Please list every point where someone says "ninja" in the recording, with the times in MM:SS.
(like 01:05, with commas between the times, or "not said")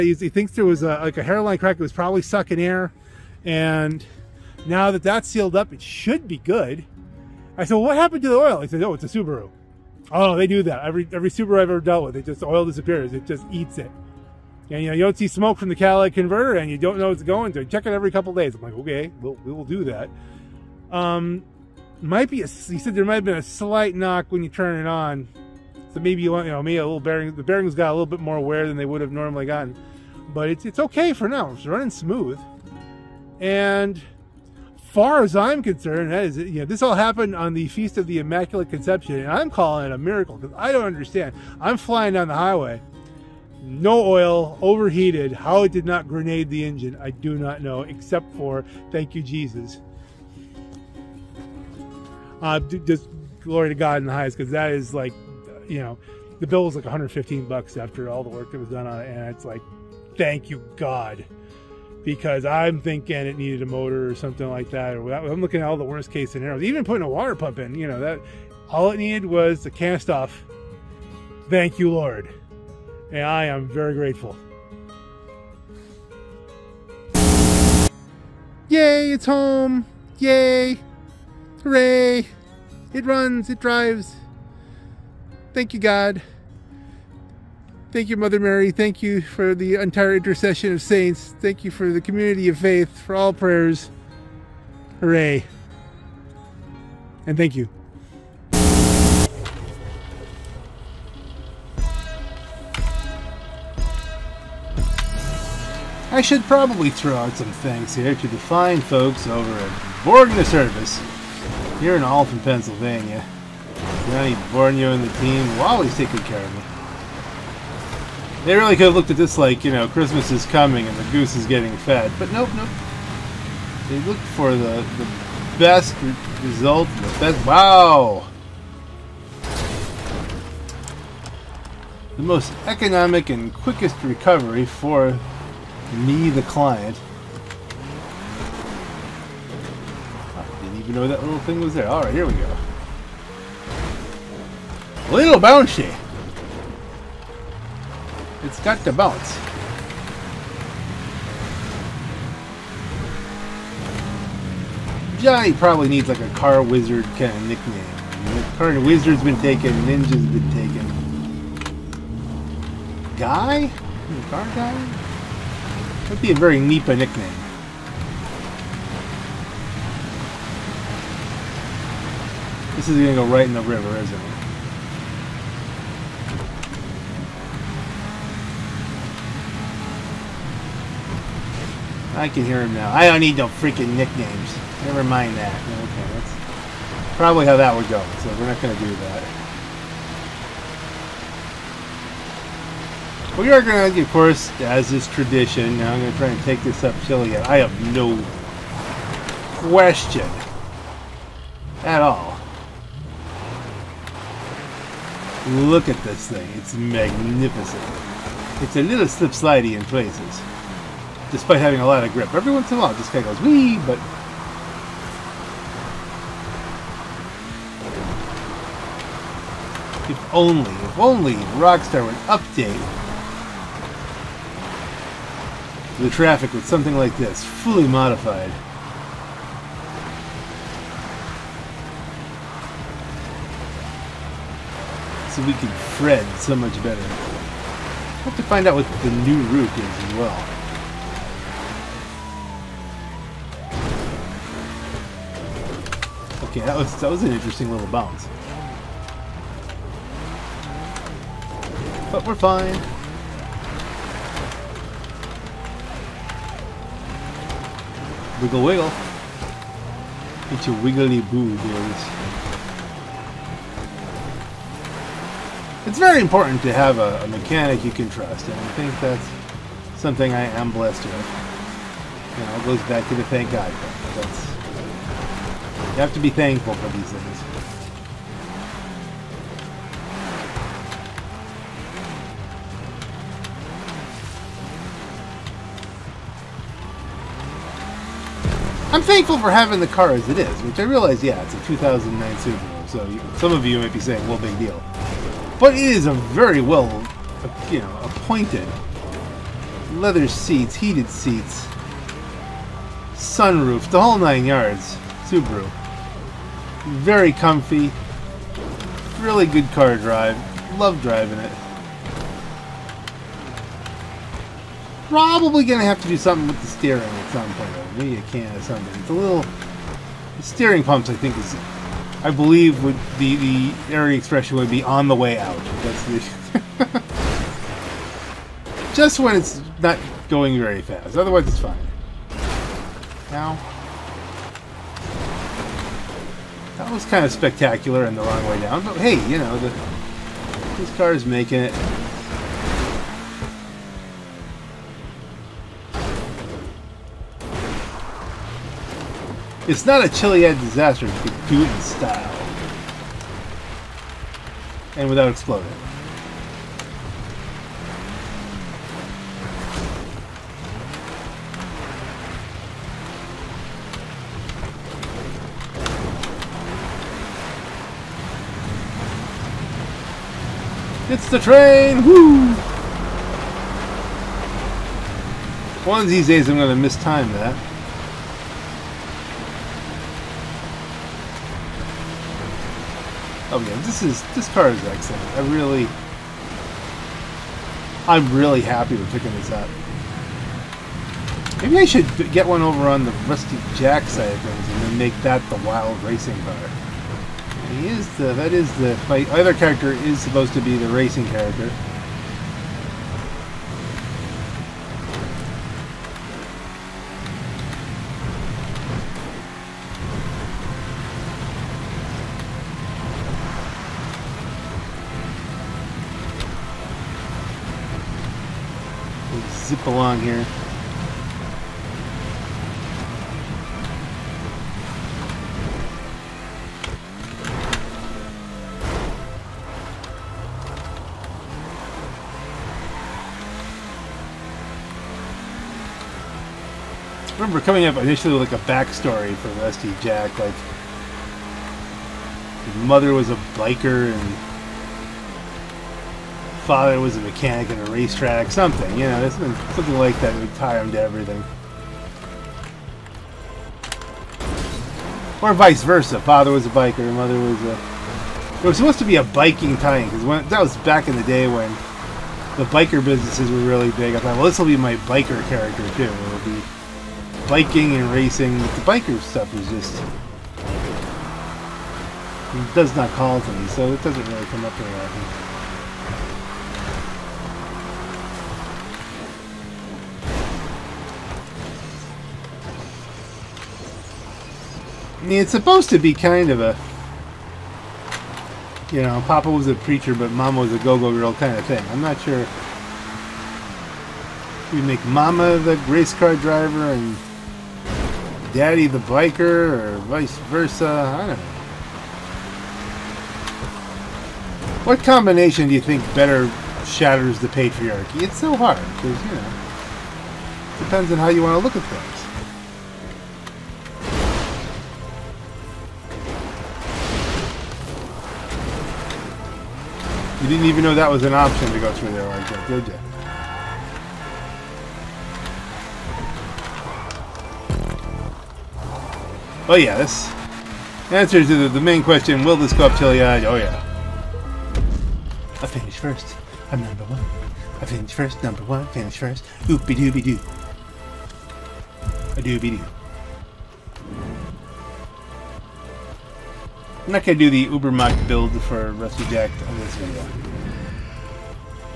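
02:39.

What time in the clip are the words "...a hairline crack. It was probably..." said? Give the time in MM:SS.
00:01.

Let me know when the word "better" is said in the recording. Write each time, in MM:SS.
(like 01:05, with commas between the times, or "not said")
03:56, 08:26.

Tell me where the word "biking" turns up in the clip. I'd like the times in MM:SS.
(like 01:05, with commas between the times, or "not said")
07:39, 07:47.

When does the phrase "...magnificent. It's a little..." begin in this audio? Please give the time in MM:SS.
03:26.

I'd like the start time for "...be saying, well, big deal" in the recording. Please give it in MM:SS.
04:53.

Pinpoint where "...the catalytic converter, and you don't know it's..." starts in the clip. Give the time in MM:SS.
00:15.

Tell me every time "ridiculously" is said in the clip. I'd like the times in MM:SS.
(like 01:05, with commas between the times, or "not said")
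not said.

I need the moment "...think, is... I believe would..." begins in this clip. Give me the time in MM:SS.
05:21.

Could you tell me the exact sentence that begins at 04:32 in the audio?
You know, it goes back to the thank God thing.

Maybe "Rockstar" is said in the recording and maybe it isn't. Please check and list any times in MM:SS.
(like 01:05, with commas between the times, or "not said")
03:41.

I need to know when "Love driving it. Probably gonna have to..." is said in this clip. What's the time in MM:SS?
05:10.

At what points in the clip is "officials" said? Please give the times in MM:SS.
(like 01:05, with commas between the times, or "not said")
not said.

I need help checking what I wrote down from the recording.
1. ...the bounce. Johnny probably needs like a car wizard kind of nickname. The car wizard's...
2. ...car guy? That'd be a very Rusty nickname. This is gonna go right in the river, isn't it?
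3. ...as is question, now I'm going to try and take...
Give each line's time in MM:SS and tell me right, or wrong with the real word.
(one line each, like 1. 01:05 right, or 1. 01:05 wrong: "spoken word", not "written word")
1. 02:28 right
2. 02:44 wrong: "Nipa", not "Rusty"
3. 03:14 wrong: "tradition", not "question".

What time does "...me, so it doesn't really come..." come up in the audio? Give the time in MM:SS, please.
07:53.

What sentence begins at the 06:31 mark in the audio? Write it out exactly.
Maybe I should get one over on the Rusty Jack side of things and then make that the wild racing car.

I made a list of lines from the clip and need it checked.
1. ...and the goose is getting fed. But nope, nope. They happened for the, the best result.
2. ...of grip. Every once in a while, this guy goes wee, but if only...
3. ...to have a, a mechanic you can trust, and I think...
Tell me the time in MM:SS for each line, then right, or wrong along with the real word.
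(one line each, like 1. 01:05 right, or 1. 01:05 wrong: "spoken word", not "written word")
1. 02:00 wrong: "looked", not "happened"
2. 03:32 right
3. 04:26 right.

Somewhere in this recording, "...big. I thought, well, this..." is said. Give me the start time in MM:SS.
07:43.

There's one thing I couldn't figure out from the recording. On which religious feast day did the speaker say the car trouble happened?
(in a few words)
Feast of the Immaculate Conception.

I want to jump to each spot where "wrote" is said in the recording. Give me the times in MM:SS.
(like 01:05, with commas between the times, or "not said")
not said.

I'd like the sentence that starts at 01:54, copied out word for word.
Johnny Borgna and the team always taking care of me.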